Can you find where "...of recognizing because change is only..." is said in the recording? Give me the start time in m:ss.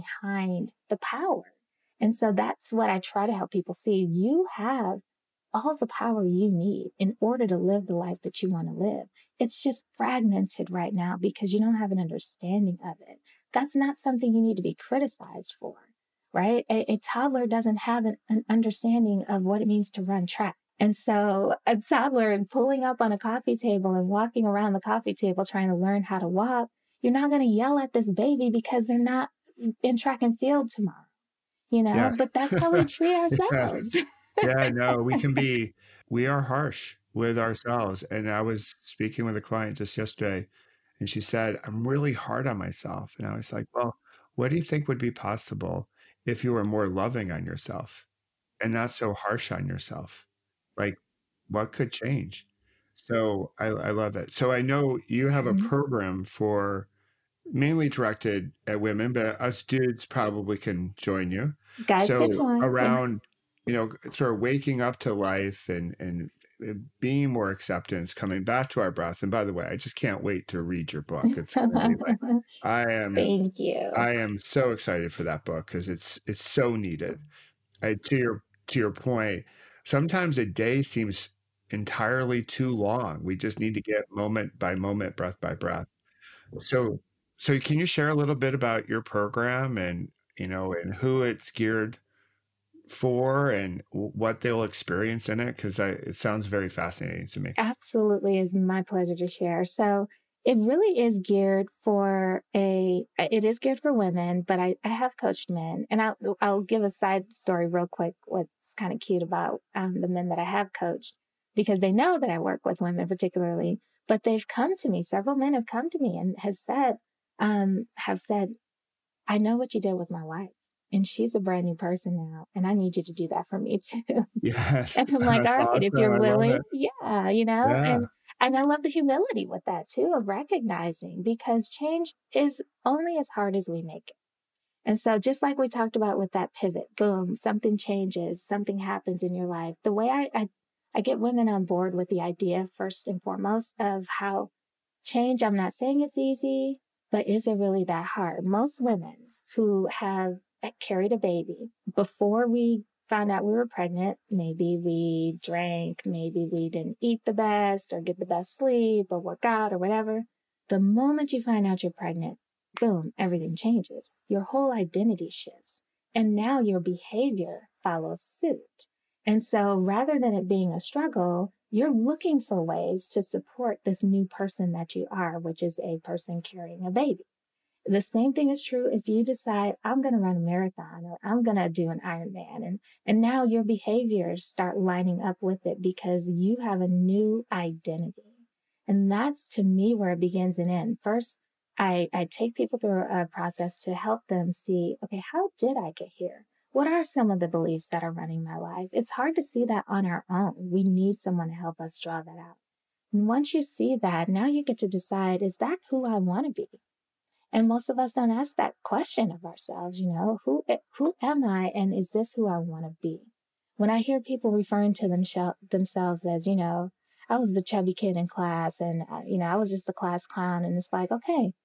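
2:10.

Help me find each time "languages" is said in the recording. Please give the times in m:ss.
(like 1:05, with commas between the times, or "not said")
not said.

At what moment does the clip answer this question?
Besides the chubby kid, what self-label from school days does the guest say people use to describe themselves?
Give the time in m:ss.
3:39.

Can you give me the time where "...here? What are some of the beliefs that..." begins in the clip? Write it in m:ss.
3:16.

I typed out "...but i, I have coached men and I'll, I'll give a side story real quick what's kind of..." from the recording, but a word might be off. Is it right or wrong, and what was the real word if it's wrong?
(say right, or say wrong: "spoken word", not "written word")
right.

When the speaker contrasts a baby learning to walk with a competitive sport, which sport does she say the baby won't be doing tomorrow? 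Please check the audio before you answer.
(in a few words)
Track and field.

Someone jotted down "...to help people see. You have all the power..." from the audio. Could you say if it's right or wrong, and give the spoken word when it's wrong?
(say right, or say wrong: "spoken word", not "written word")
right.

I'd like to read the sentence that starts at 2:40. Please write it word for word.
The moment you find out you're pregnant, boom, everything changes.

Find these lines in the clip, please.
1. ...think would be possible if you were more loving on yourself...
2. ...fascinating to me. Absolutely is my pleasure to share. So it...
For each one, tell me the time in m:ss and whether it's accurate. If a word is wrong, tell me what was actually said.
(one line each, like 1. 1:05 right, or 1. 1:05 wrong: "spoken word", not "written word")
1. 0:44 right
2. 1:36 right.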